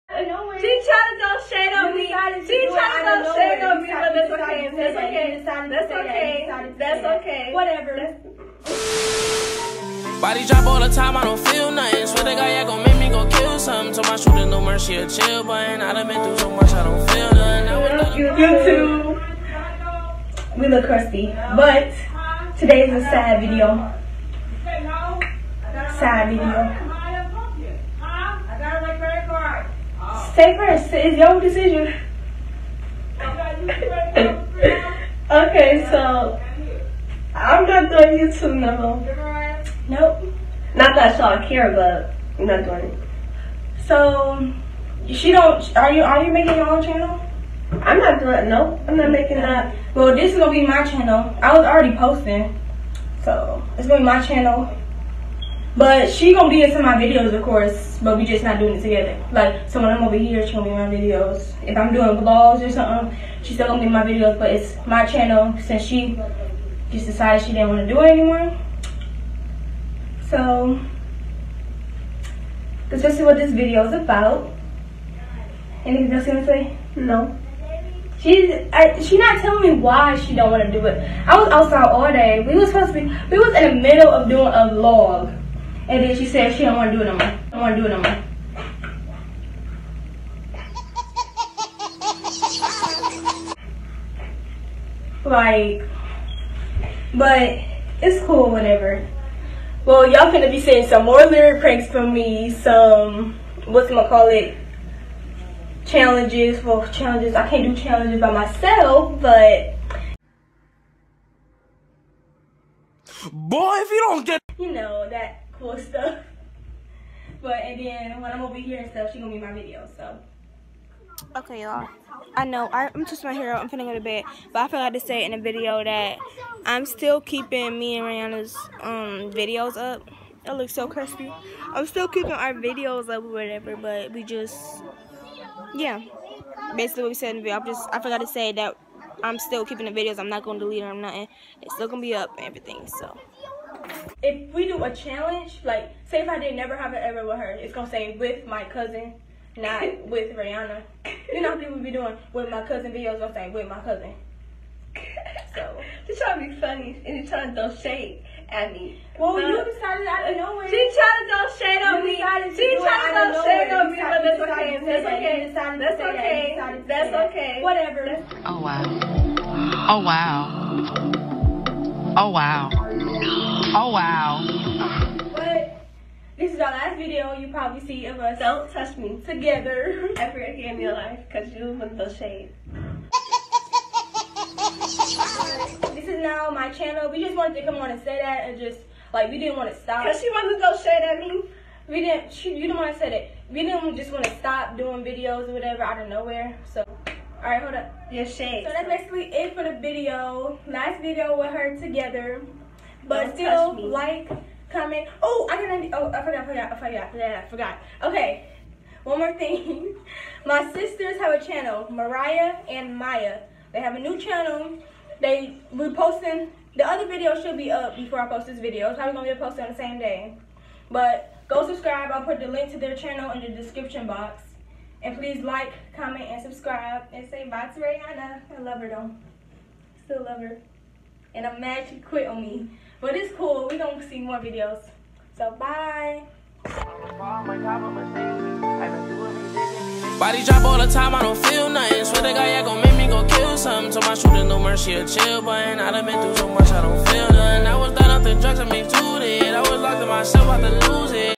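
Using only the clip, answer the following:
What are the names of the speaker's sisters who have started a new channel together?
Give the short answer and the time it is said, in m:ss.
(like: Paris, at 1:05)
Mariah and Maya, at 3:31.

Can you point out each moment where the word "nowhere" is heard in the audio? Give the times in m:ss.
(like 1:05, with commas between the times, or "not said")
2:40, 3:16.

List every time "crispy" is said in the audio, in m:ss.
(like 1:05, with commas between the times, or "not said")
2:10.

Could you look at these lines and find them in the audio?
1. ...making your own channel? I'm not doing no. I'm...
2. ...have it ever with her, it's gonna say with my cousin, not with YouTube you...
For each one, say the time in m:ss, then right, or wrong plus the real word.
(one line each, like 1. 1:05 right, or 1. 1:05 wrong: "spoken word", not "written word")
1. 0:46 right
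2. 2:26 wrong: "Rayanna", not "YouTube".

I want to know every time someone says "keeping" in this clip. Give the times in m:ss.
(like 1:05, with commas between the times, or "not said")
2:07, 2:12, 2:19.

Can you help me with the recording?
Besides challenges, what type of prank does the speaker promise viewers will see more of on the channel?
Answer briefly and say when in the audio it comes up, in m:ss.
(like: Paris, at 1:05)
lyric pranks, at 1:41.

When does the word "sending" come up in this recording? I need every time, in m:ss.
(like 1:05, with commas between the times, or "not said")
not said.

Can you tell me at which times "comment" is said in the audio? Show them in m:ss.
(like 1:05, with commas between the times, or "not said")
3:24, 3:45.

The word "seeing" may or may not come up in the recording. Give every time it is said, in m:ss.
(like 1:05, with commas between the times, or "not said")
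1:40.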